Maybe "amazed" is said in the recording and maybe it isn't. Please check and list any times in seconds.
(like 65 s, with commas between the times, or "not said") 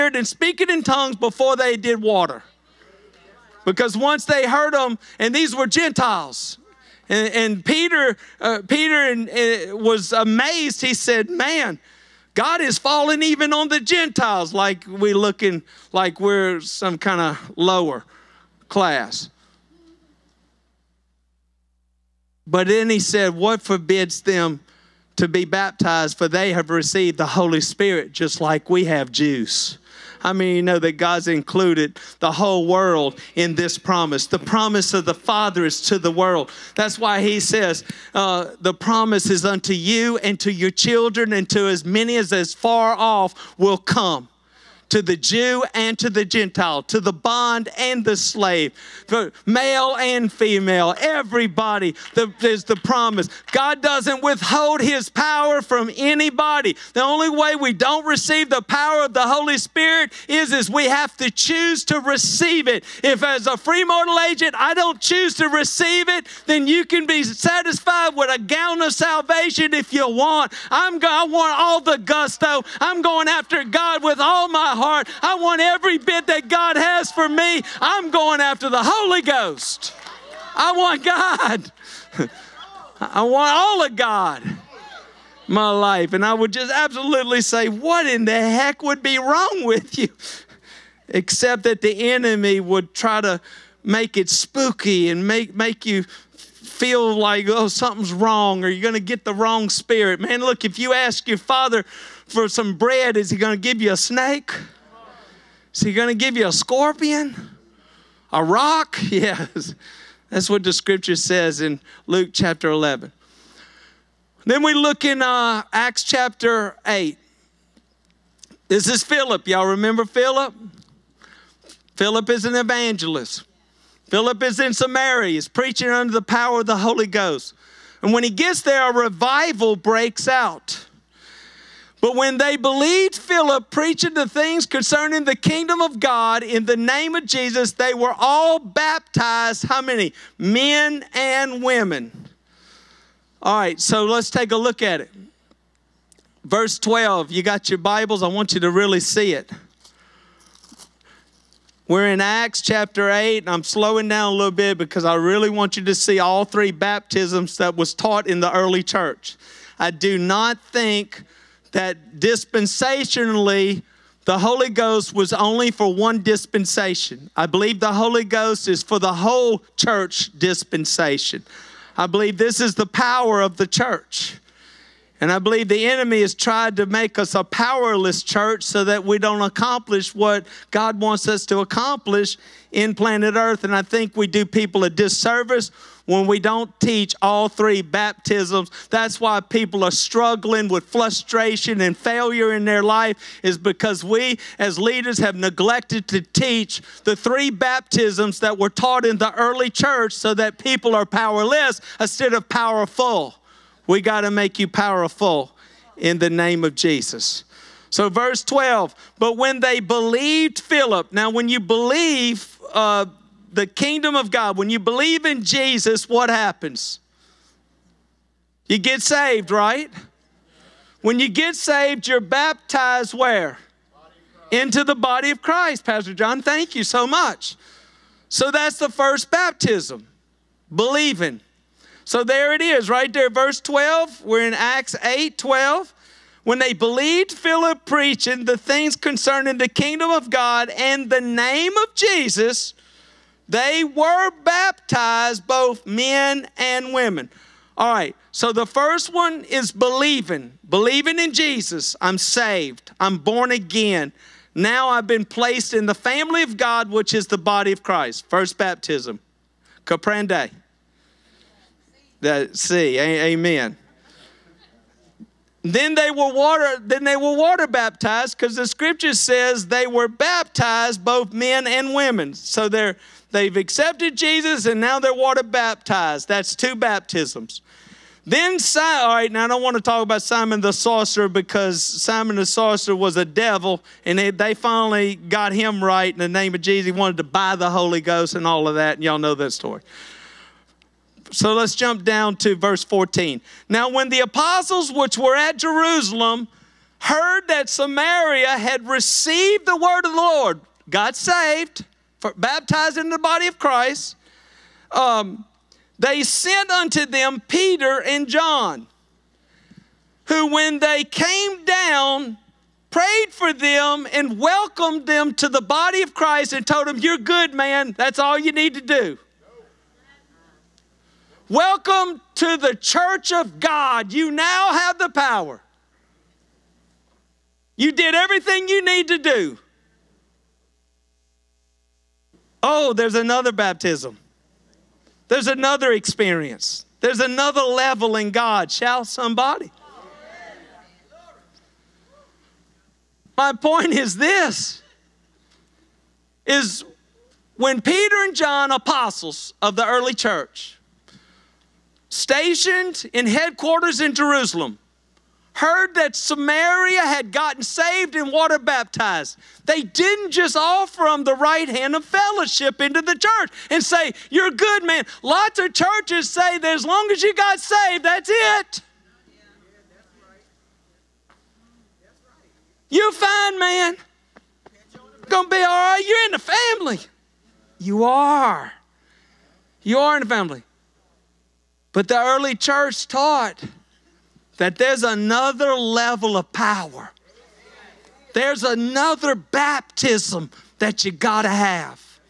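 10 s.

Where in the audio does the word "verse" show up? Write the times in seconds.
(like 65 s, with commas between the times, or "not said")
146 s, 208 s, 233 s, 292 s.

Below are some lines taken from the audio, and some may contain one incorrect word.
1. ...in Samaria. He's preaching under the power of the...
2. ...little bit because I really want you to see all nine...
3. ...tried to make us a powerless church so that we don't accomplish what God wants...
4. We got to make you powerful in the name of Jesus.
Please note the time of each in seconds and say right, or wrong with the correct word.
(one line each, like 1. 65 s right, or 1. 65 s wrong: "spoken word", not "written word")
1. 124 s right
2. 154 s wrong: "three", not "nine"
3. 176 s right
4. 203 s right.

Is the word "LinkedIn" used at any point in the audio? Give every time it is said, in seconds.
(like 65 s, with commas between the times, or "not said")
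not said.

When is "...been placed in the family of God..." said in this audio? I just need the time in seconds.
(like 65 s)
255 s.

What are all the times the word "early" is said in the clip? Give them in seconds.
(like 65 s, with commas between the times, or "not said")
158 s, 199 s, 349 s, 382 s.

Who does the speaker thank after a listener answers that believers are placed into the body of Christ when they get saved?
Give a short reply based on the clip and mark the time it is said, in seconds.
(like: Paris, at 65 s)
Pastor John, at 225 s.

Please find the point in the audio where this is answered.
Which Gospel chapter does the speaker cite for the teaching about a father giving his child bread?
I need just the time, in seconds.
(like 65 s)
112 s.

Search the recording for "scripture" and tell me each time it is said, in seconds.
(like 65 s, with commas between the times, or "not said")
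110 s, 268 s.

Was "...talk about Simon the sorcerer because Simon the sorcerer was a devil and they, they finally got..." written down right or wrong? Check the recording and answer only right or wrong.
right.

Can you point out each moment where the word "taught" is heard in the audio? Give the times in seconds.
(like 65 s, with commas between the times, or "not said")
157 s, 198 s, 383 s.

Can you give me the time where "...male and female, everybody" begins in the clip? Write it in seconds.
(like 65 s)
49 s.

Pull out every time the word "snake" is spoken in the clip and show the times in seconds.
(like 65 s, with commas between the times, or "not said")
103 s.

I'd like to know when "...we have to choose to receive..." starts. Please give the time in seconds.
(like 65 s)
60 s.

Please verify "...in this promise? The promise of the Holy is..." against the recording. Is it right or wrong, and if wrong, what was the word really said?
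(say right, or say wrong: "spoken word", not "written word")
wrong: "Father", not "Holy".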